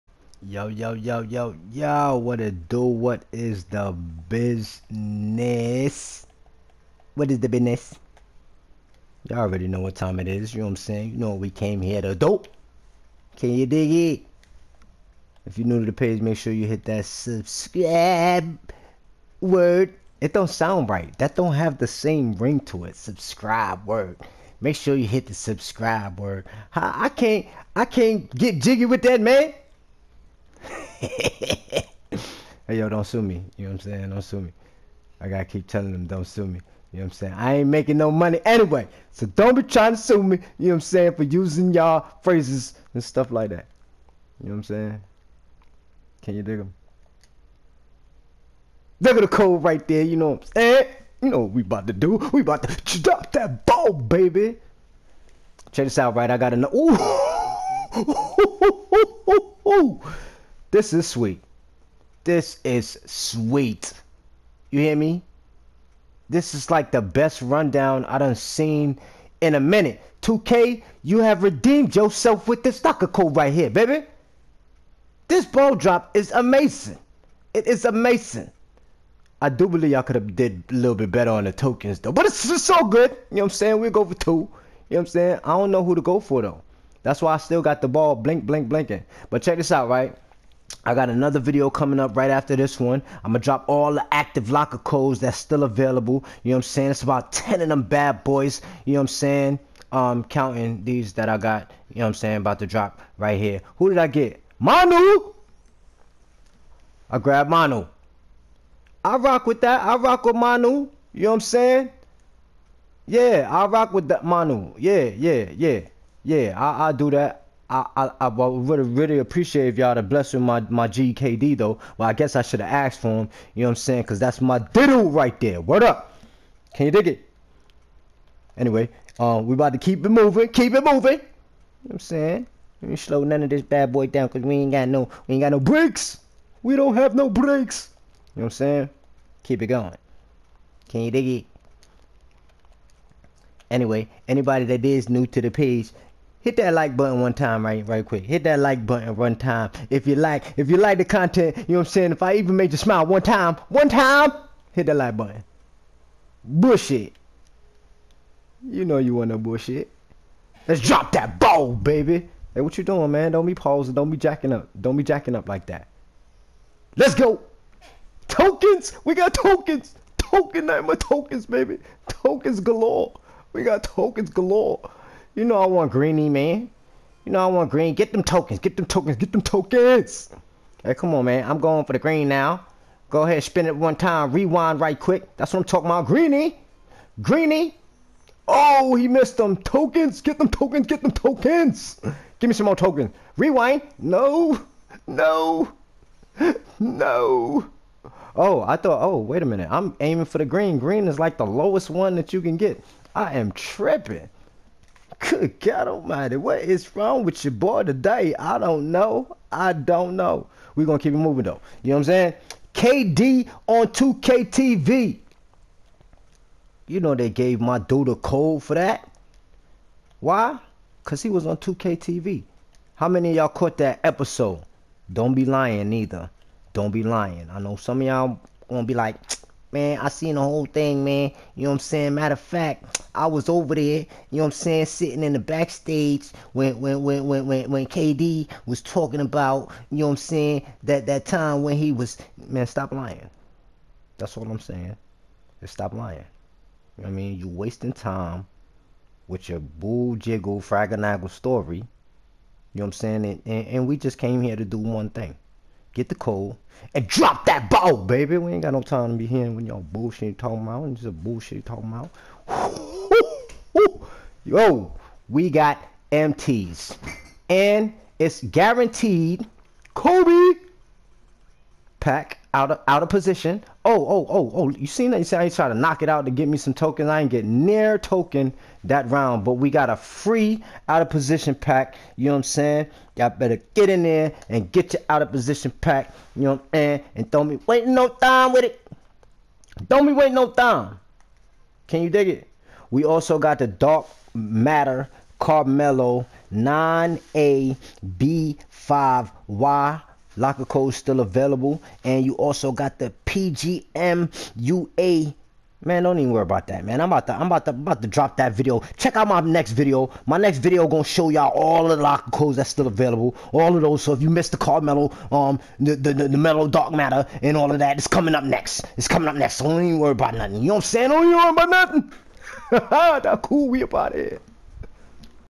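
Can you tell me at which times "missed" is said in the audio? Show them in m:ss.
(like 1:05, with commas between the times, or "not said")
3:09, 5:14.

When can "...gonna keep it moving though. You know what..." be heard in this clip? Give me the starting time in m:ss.
3:30.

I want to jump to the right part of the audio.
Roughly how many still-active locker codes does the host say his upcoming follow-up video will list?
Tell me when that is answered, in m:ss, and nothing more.
1:37.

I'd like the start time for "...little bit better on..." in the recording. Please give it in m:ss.
1:20.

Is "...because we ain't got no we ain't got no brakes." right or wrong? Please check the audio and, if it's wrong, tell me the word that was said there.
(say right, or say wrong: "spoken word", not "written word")
right.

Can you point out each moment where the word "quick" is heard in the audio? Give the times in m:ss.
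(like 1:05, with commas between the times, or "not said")
2:28, 3:04.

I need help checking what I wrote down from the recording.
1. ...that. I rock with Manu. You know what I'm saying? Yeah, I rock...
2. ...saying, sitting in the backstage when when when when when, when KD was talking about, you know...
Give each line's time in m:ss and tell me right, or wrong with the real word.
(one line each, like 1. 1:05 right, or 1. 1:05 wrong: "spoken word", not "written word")
1. 1:49 right
2. 3:54 right.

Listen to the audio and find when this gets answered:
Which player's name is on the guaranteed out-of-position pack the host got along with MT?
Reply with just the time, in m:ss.
4:29.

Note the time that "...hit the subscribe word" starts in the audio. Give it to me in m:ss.
0:25.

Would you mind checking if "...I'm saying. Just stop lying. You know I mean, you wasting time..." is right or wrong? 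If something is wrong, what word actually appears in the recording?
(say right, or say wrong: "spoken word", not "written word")
right.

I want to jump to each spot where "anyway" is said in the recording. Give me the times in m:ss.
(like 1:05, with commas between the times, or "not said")
0:38, 2:08, 2:23.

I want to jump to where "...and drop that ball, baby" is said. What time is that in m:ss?
4:16.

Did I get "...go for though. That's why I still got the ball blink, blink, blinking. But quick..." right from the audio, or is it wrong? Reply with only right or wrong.
wrong.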